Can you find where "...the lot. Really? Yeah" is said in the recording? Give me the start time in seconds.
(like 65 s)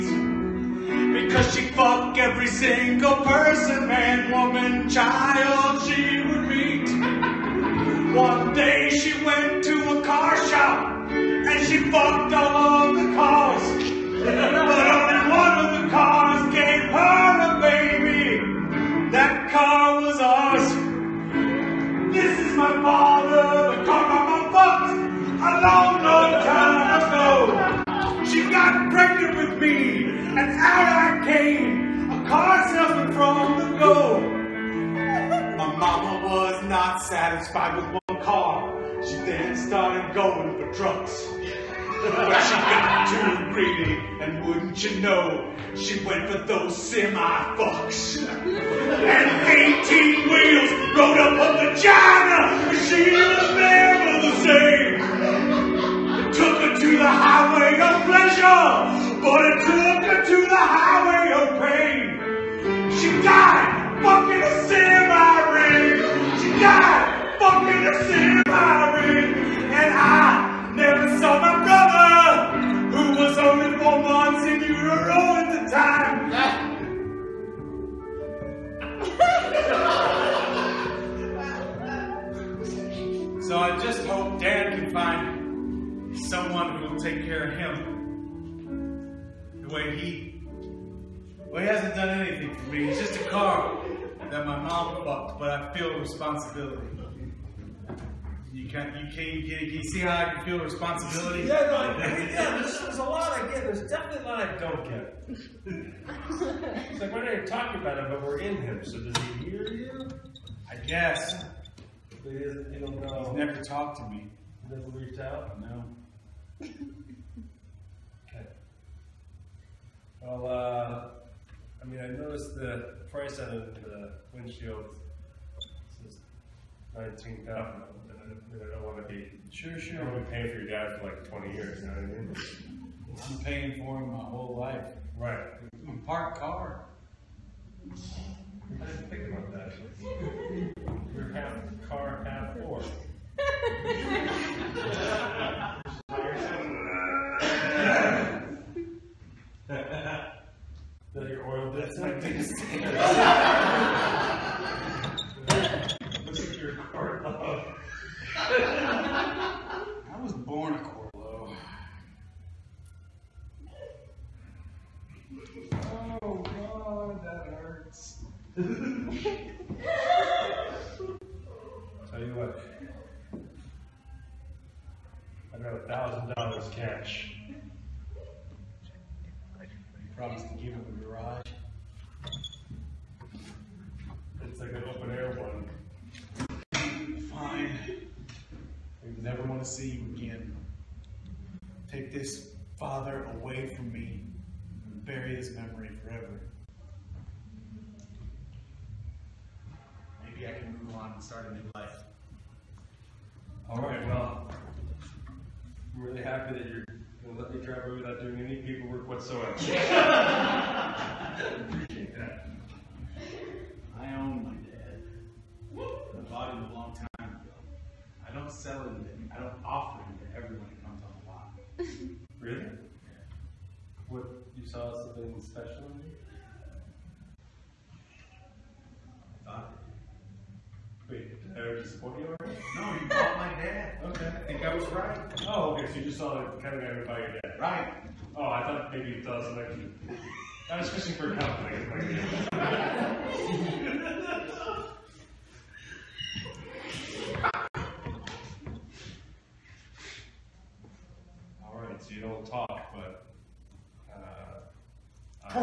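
221 s.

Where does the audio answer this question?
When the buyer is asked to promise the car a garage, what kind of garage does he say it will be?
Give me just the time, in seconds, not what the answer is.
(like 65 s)
184 s.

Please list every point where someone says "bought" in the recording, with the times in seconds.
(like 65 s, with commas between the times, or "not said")
95 s, 216 s, 233 s.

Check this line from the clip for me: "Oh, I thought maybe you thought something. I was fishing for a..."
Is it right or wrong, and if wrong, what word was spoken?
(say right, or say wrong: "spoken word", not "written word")
right.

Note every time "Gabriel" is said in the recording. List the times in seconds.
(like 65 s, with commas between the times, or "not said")
not said.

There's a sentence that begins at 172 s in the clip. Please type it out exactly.
Tell you what about a thousand dollars cash.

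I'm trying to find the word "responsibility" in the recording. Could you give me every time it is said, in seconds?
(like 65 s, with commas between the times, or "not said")
95 s, 100 s.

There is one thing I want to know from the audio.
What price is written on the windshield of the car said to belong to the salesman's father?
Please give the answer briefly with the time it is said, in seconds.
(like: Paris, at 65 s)
19000, at 126 s.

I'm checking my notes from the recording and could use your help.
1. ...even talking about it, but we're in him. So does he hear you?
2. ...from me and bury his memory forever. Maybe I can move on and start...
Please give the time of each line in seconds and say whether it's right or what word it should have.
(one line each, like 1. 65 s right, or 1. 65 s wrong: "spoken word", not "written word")
1. 107 s right
2. 193 s right.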